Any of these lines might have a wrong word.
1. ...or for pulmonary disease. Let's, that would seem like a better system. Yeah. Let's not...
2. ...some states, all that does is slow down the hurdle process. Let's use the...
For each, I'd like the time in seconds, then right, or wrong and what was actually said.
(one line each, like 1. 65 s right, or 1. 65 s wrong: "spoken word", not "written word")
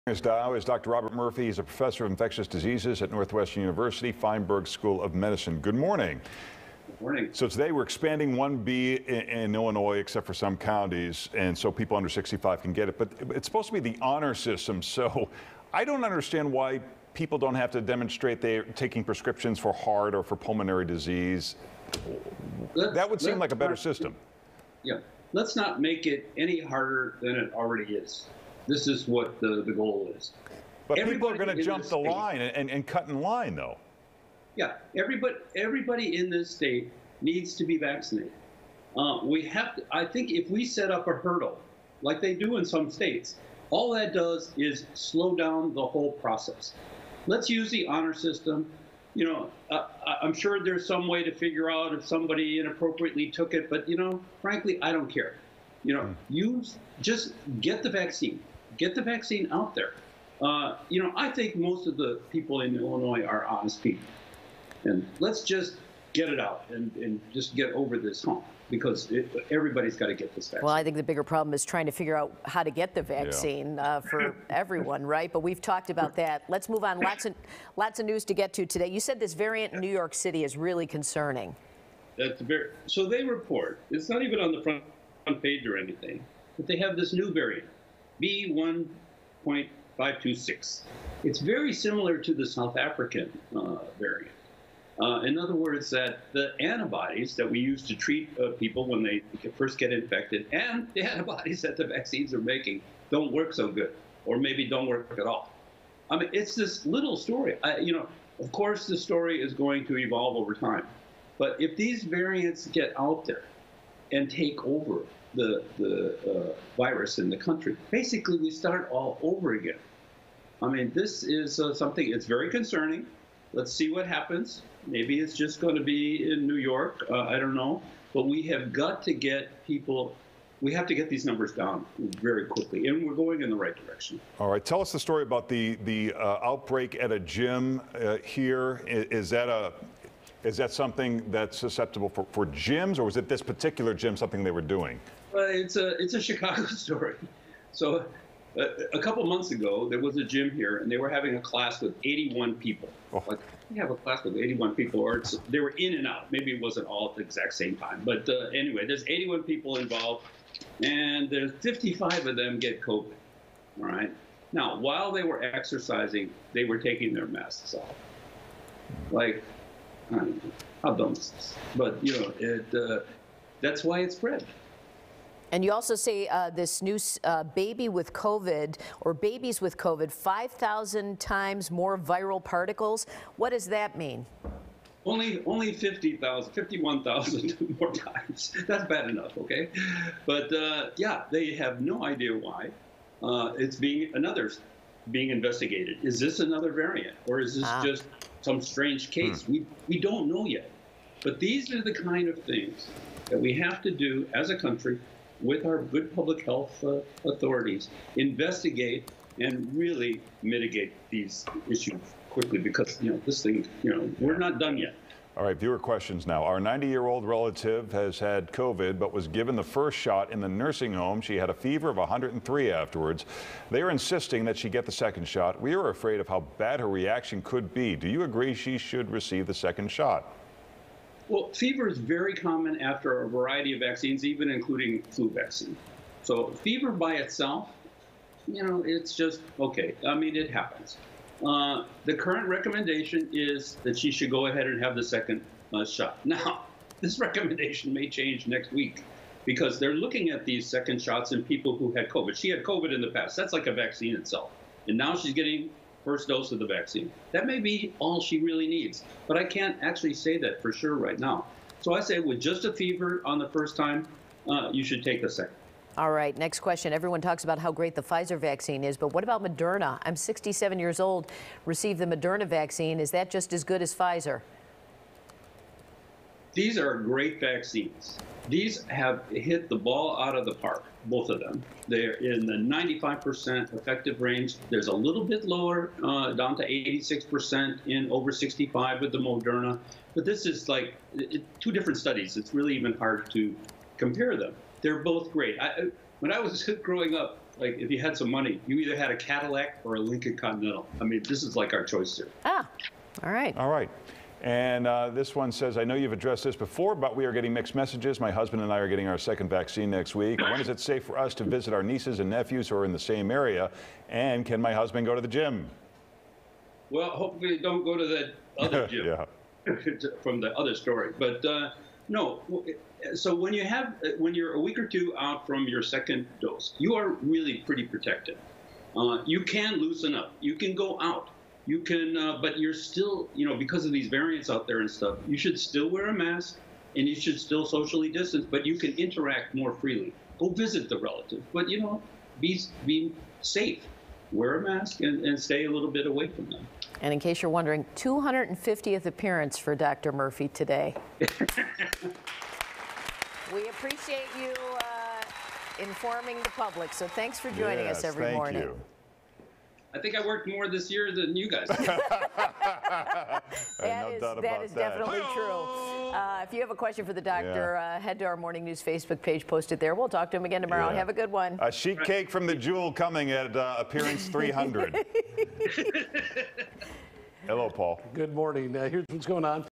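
1. 20 s right
2. 42 s wrong: "whole", not "hurdle".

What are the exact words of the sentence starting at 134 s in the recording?
All right, tell us the story about the the uh, outbreak at a gym uh, here.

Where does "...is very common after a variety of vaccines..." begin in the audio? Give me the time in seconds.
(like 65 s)
231 s.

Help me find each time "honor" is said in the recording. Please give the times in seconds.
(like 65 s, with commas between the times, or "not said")
14 s, 47 s.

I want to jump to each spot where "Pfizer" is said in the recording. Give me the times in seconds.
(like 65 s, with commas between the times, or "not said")
268 s, 273 s.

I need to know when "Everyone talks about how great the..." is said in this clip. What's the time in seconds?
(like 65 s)
266 s.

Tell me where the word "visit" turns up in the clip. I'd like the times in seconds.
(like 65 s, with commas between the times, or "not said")
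311 s, 340 s.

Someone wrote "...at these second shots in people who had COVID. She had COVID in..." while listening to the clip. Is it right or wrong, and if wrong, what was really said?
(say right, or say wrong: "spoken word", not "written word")
right.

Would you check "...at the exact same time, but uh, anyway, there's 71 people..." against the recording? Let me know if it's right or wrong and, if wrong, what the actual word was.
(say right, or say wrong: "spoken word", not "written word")
wrong: "81", not "71".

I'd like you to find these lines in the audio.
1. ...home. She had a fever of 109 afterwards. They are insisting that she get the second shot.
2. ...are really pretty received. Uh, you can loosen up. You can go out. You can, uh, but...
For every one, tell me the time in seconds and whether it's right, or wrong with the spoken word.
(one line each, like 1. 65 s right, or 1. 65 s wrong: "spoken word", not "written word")
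1. 220 s wrong: "103", not "109"
2. 326 s wrong: "protected", not "received".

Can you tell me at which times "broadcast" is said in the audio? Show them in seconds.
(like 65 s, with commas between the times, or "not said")
not said.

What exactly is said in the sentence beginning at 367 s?
uh, head to our morning news Facebook page, post it there.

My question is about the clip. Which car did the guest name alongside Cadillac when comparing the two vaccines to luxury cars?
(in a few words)
Lincoln Continental.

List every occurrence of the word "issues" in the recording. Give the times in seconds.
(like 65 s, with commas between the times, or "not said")
211 s.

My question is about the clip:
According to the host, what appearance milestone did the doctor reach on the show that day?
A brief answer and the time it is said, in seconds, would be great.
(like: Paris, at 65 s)
250th, at 347 s.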